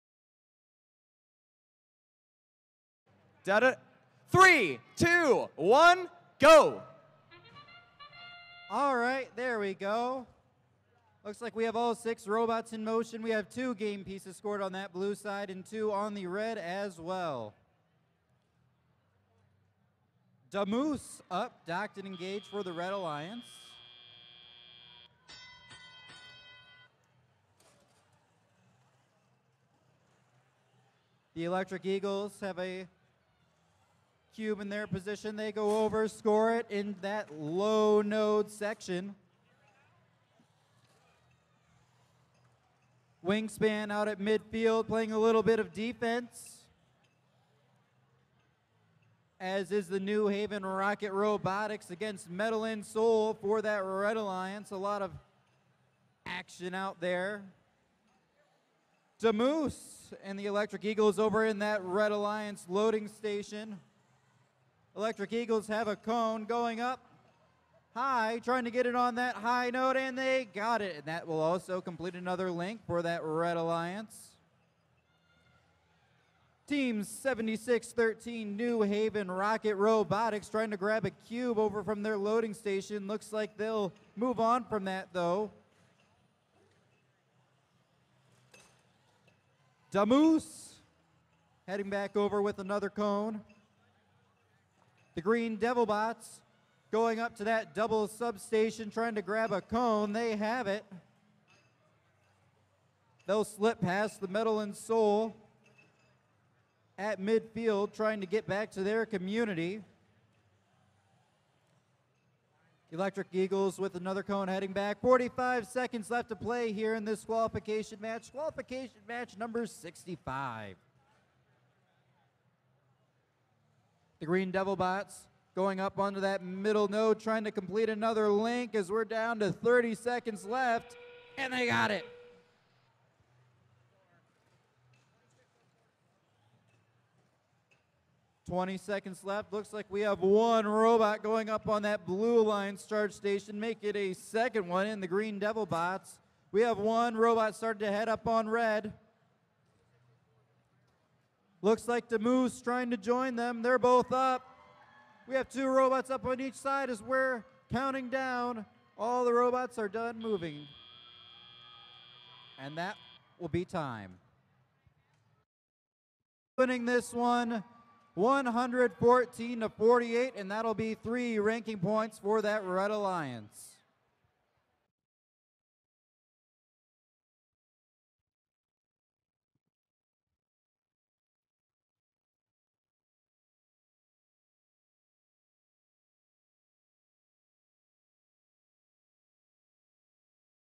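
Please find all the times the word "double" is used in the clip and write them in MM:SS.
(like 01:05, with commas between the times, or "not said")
01:37.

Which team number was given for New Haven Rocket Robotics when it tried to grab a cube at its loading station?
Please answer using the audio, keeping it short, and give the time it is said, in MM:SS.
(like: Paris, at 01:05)
7613, at 01:16.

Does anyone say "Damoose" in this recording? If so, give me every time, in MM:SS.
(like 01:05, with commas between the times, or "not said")
00:20, 00:59, 01:29.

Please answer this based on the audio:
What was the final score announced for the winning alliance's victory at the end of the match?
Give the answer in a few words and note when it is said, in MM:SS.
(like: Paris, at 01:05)
114 to 48, at 02:48.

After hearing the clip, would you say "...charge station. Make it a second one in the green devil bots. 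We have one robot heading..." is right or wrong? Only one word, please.
wrong.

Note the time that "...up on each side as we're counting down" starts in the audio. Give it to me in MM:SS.
02:36.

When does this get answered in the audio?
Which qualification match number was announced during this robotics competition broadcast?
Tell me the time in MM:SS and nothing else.
01:58.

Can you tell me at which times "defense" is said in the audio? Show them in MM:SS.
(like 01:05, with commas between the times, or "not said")
00:45.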